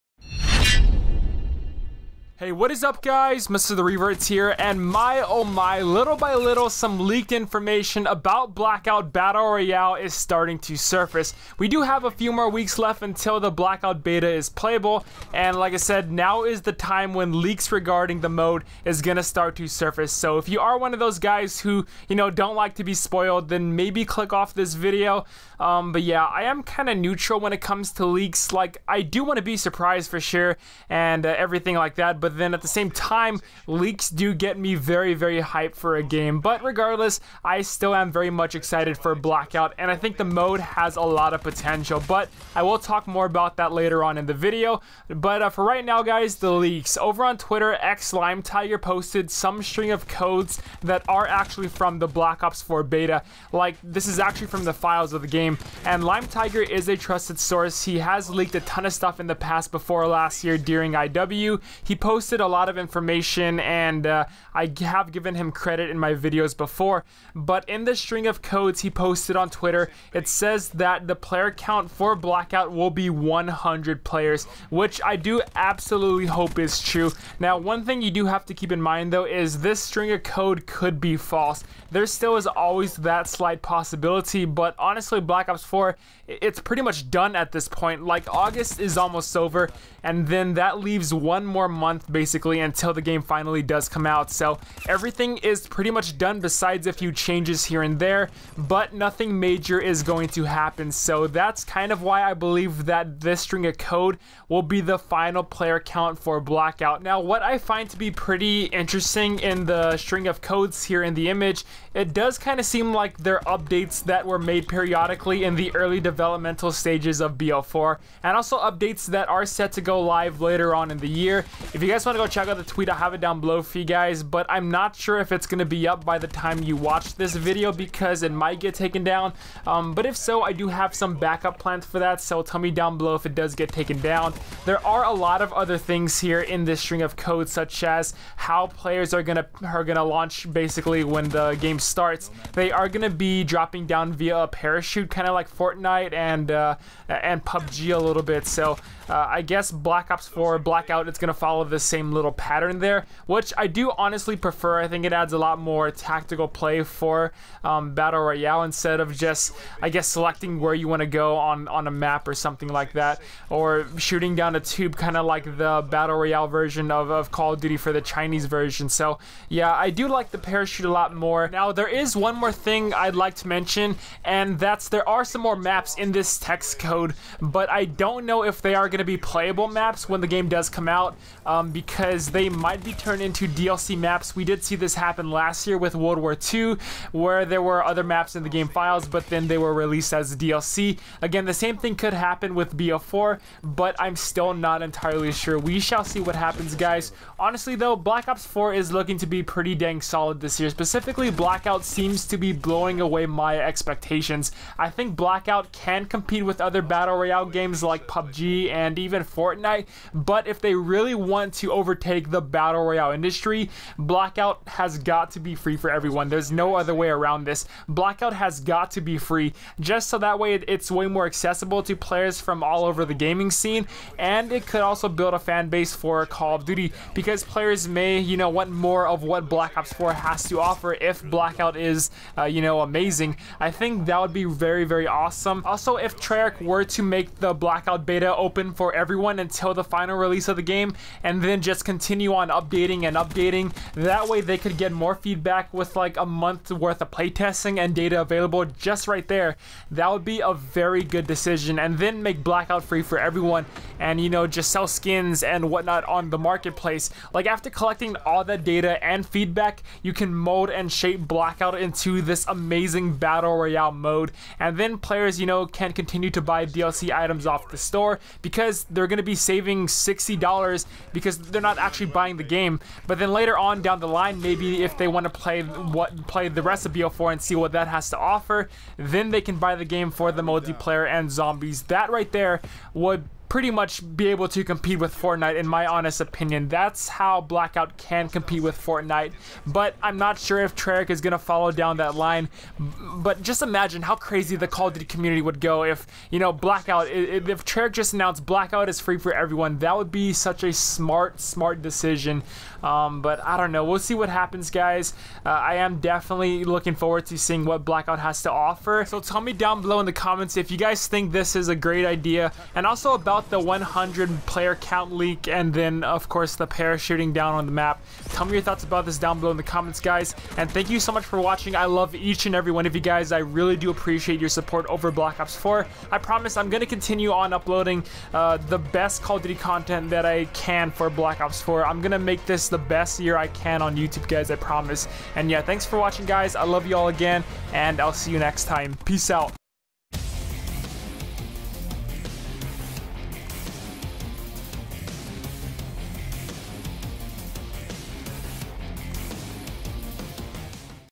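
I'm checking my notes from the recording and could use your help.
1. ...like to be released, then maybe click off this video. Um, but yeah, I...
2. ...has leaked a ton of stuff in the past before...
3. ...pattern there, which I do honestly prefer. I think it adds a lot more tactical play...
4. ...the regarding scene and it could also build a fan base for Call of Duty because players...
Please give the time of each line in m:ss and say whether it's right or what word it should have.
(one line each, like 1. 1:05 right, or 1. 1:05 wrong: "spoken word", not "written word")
1. 0:22 wrong: "spoiled", not "released"
2. 0:57 right
3. 2:32 right
4. 3:43 wrong: "gaming", not "regarding".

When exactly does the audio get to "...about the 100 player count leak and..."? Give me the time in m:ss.
5:13.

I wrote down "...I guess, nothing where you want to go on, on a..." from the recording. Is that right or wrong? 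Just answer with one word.
wrong.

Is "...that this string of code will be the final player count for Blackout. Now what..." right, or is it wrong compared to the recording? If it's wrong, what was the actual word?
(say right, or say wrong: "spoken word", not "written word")
right.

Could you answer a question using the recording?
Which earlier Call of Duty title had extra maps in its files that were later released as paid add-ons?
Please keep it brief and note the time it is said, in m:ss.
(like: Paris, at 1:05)
World War II, at 3:05.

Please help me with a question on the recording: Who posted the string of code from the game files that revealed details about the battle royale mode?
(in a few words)
Lime Tiger.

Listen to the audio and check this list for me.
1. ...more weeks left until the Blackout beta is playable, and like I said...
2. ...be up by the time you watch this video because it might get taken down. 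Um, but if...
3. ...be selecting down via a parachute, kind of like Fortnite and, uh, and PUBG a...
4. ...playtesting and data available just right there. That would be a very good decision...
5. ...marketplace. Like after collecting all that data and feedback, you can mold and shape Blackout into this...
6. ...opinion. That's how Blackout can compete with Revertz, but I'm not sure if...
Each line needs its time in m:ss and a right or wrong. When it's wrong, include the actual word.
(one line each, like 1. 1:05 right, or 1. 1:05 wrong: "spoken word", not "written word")
1. 0:12 right
2. 2:05 right
3. 2:23 wrong: "dropping", not "selecting"
4. 4:07 right
5. 4:16 right
6. 4:46 wrong: "Fortnite", not "Revertz".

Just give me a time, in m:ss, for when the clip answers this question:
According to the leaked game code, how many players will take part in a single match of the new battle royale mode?
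1:13.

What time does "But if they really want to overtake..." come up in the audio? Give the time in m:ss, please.
3:30.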